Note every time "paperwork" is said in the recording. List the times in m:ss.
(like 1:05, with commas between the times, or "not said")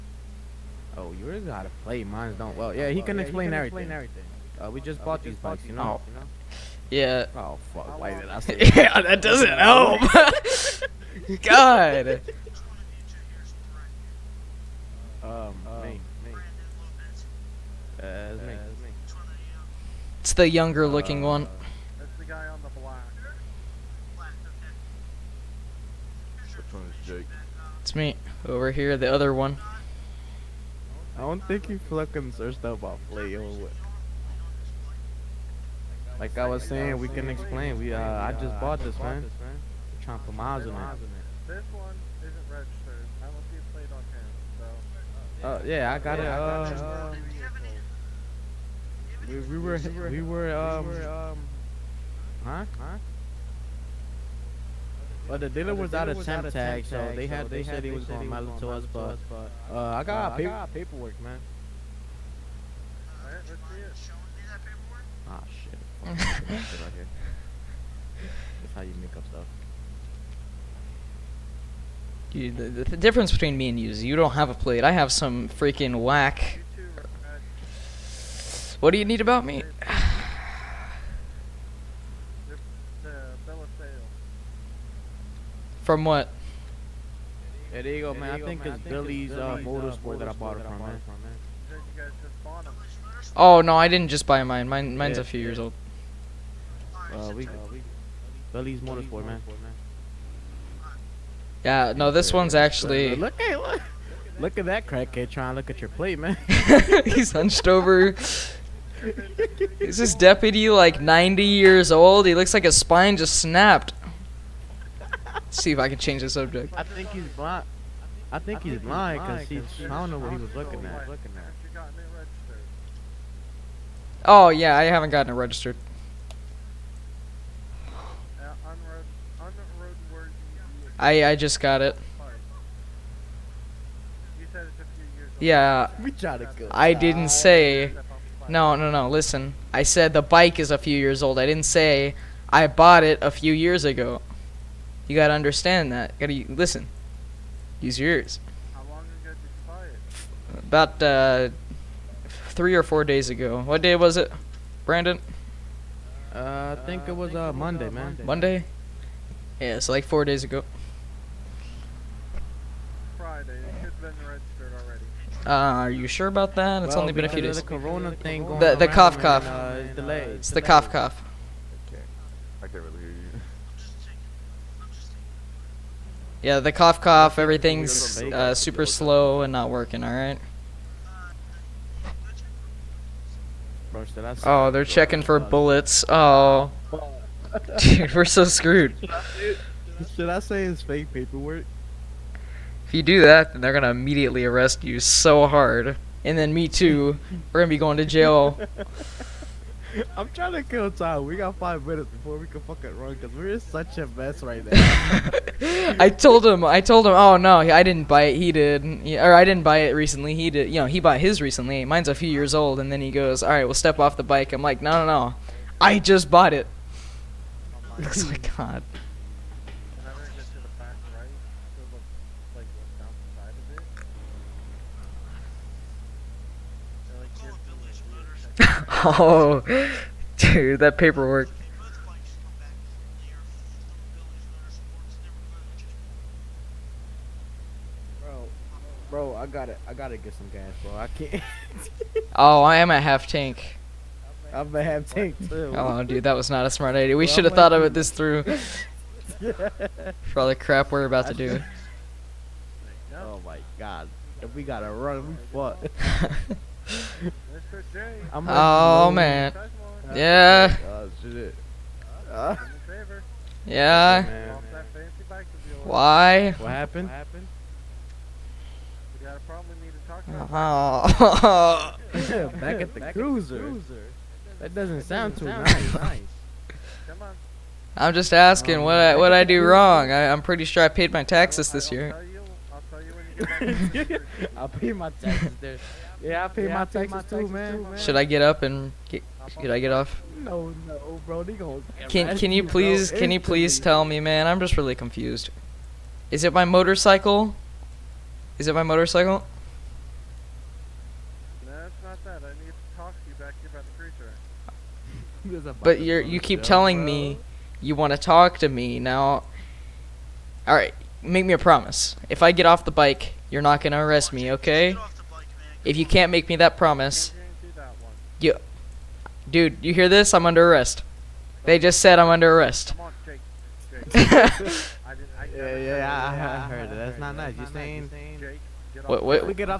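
1:00, 3:11, 3:50.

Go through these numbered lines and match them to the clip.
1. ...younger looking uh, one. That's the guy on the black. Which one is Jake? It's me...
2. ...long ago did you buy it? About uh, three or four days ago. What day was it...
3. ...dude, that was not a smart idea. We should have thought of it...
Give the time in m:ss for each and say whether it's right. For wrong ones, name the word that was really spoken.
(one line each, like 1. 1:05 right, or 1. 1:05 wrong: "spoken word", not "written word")
1. 0:20 right
2. 2:28 right
3. 4:06 right.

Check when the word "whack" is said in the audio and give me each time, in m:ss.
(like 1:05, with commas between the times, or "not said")
1:16.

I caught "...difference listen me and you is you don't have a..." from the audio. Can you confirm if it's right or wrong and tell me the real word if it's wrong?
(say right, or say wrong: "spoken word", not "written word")
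wrong: "between", not "listen".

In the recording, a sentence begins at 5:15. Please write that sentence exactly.
If you can't make me that promise, you, dude, you hear this?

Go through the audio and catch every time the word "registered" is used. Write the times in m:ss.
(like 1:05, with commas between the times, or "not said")
0:42, 2:05, 2:44.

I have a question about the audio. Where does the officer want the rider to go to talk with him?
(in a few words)
The cruiser.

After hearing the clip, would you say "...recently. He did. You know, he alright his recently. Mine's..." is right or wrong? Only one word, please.
wrong.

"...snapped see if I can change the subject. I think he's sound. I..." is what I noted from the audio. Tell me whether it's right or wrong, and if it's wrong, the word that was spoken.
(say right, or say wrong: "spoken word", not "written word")
wrong: "blind", not "sound".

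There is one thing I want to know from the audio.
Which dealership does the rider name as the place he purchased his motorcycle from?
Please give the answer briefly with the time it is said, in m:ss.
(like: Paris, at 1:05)
Billy's Motorsport, at 1:28.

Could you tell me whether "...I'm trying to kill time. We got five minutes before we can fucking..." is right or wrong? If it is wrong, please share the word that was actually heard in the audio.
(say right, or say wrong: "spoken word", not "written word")
right.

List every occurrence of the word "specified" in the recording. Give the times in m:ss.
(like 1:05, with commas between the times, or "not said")
not said.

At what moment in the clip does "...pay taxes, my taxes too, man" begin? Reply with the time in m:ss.
4:46.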